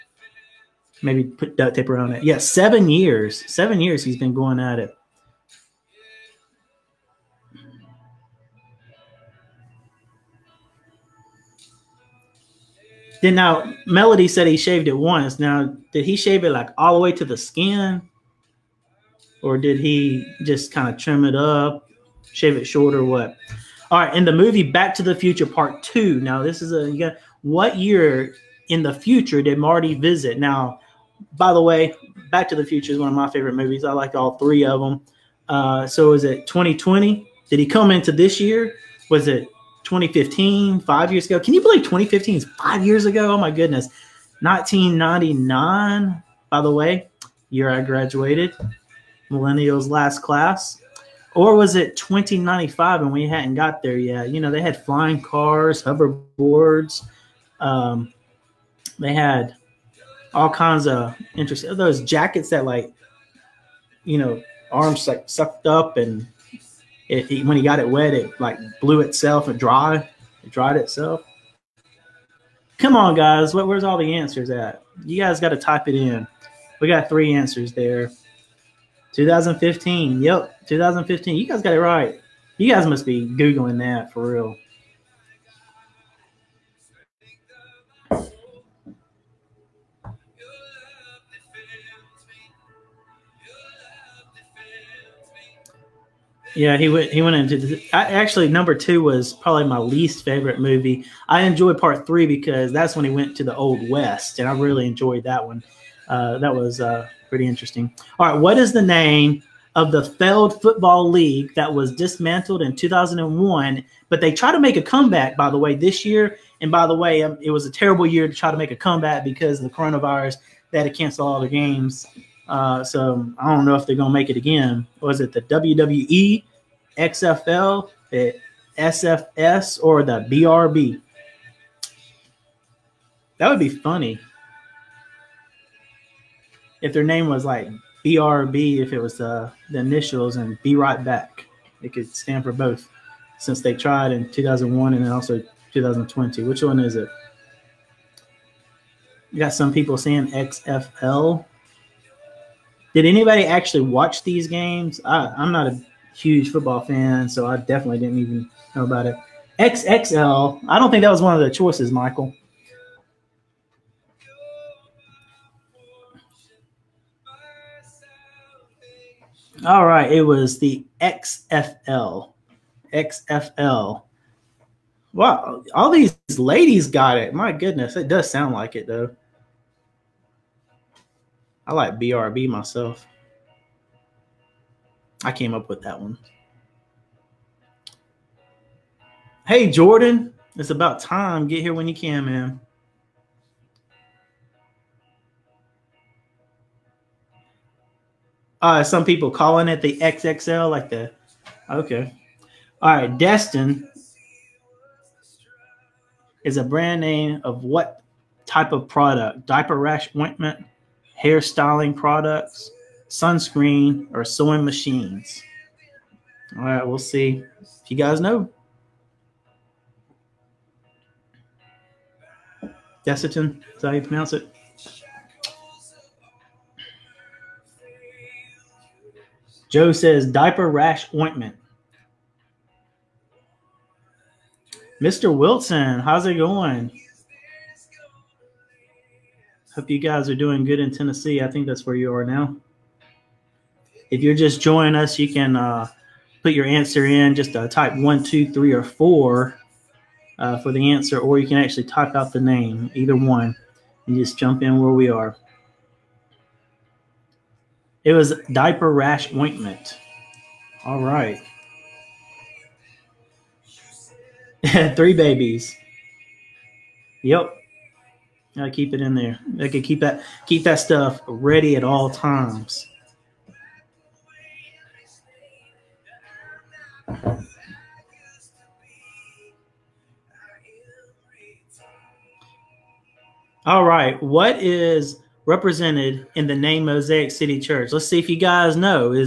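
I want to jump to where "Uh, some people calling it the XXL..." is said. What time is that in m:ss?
3:18.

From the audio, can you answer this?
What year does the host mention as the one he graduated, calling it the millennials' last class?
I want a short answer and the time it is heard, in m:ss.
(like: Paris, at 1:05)
1999, at 0:44.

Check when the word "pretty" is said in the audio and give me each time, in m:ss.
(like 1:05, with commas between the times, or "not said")
1:47.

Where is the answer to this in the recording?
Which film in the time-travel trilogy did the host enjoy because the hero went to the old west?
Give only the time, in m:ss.
1:41.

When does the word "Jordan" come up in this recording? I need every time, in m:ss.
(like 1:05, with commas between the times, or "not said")
3:09.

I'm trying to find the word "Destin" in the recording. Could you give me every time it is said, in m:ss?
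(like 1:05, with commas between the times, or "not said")
3:23.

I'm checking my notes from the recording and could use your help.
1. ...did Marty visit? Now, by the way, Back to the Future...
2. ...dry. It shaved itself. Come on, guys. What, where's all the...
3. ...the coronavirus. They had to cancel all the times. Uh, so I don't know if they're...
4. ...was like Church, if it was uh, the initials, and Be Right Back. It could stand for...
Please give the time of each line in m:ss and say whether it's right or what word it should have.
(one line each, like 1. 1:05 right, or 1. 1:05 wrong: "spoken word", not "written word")
1. 0:29 right
2. 1:09 wrong: "dried", not "shaved"
3. 1:59 wrong: "games", not "times"
4. 2:17 wrong: "BRB", not "Church".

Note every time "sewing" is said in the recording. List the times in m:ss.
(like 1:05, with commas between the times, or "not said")
3:34.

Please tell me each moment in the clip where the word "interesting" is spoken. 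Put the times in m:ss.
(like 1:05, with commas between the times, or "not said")
1:01, 1:47.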